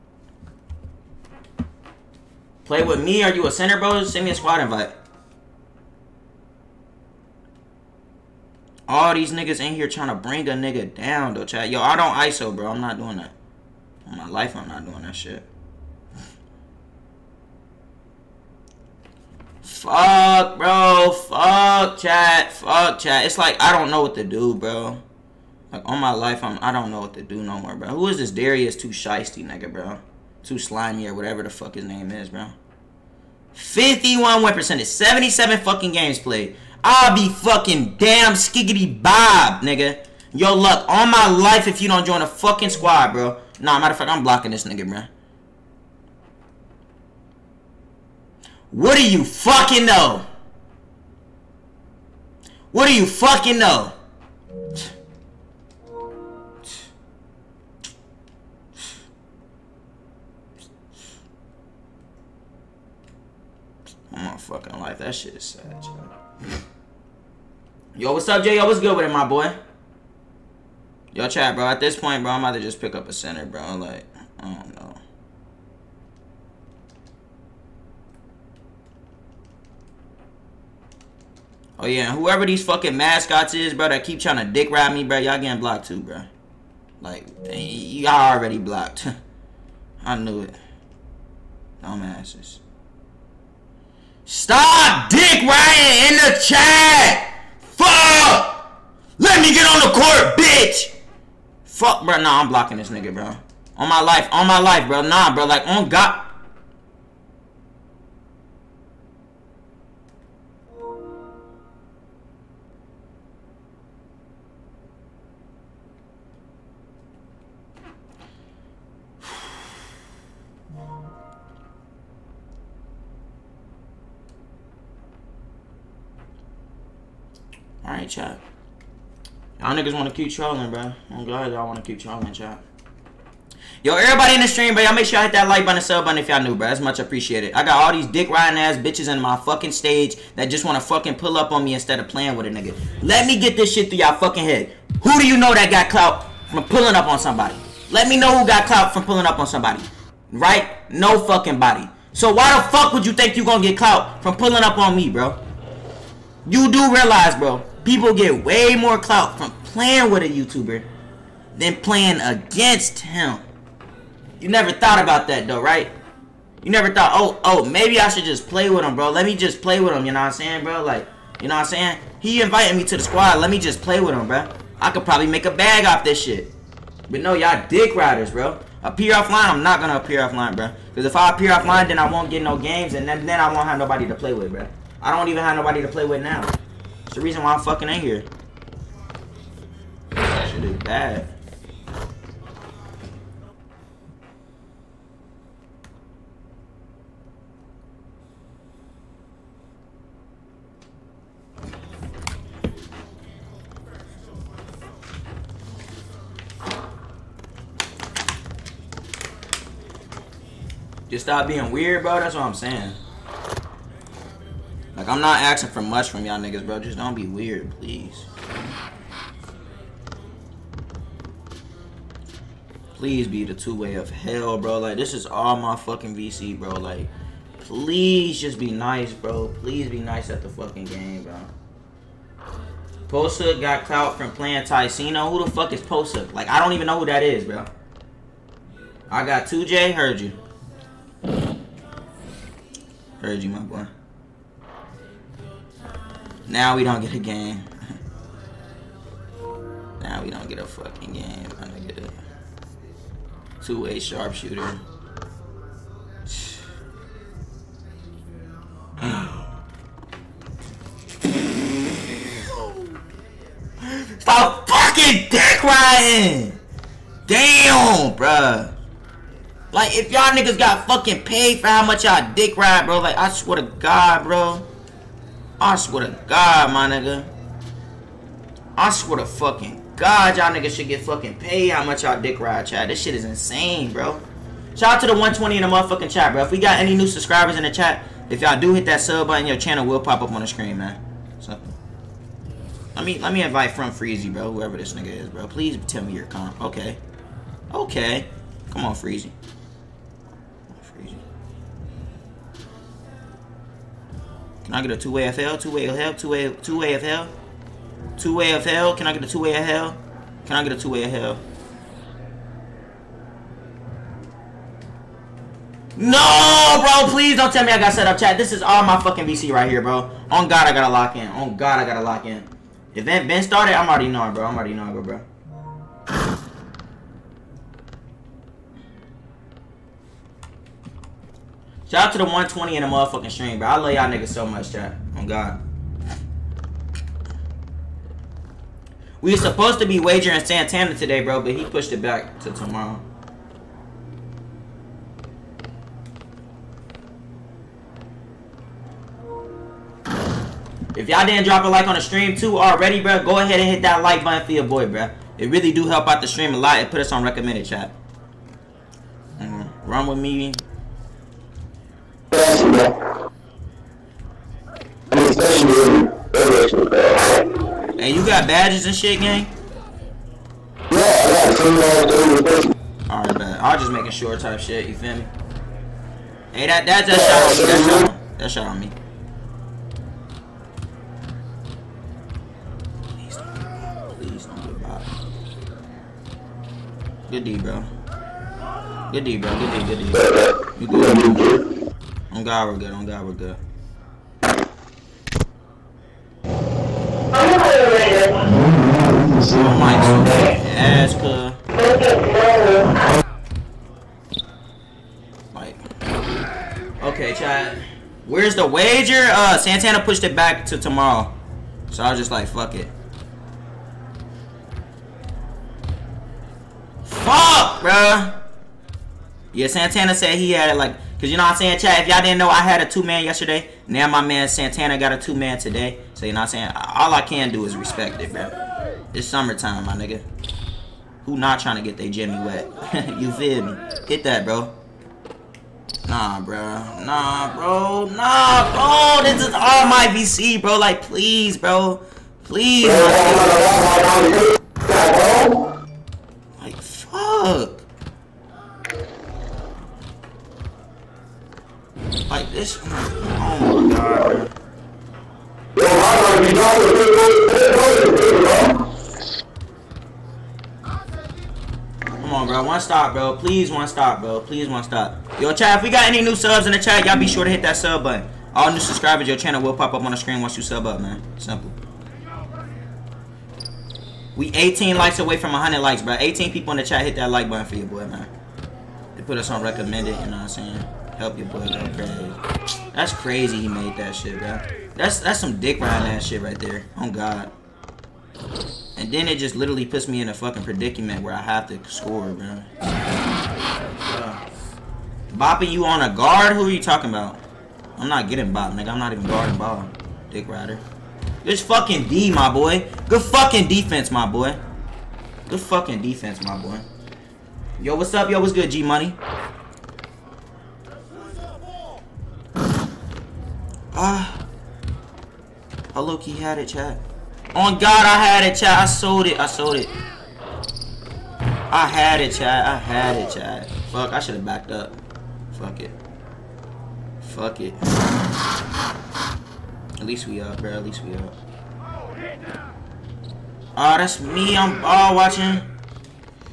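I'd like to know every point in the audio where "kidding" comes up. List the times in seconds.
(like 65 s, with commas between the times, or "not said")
not said.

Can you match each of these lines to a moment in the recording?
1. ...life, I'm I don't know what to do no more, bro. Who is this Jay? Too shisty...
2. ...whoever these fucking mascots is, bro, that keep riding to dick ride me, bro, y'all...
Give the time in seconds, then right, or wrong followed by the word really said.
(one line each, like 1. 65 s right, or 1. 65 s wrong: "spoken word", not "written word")
1. 26 s wrong: "Darius", not "Jay"
2. 82 s wrong: "trying", not "riding".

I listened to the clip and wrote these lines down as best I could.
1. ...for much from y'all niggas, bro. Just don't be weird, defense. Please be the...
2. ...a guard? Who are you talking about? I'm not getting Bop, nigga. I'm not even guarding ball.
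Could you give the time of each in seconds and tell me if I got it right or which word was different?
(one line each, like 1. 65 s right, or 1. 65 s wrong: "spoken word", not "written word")
1. 215 s wrong: "please", not "defense"
2. 496 s right.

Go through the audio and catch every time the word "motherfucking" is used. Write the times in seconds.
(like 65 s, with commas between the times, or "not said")
285 s, 332 s.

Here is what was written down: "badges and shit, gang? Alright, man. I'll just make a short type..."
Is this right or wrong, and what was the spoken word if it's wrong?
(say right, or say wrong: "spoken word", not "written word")
right.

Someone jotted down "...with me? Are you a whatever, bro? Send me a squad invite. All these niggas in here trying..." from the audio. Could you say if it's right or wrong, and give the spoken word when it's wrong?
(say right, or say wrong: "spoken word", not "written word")
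wrong: "center", not "whatever".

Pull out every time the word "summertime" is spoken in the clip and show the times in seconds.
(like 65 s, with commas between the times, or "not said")
429 s.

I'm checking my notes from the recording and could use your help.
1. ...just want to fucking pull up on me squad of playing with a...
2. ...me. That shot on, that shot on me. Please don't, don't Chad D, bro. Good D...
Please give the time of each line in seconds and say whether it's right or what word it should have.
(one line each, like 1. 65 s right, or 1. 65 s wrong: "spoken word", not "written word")
1. 140 s wrong: "instead", not "squad"
2. 377 s wrong: "Good", not "Chad".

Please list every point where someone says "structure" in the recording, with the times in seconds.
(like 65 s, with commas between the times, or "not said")
not said.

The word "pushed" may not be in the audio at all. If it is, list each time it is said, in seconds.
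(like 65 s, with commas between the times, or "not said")
341 s, 410 s.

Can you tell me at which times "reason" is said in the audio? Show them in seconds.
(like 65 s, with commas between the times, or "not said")
187 s.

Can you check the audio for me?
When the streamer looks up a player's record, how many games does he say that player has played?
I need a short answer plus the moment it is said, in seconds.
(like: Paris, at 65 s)
77, at 34 s.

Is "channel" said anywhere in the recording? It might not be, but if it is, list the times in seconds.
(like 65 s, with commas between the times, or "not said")
289 s, 469 s.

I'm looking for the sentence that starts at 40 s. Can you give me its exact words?
Yo, luck, On my life if you don't join a fucking squad, bro.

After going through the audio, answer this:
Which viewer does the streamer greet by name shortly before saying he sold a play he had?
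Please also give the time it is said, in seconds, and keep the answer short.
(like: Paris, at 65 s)
G-Money, at 508 s.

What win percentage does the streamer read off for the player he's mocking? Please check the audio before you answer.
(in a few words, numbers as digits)
51.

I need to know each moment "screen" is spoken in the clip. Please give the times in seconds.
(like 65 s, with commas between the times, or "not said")
290 s, 470 s.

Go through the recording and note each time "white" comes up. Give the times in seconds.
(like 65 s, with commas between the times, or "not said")
not said.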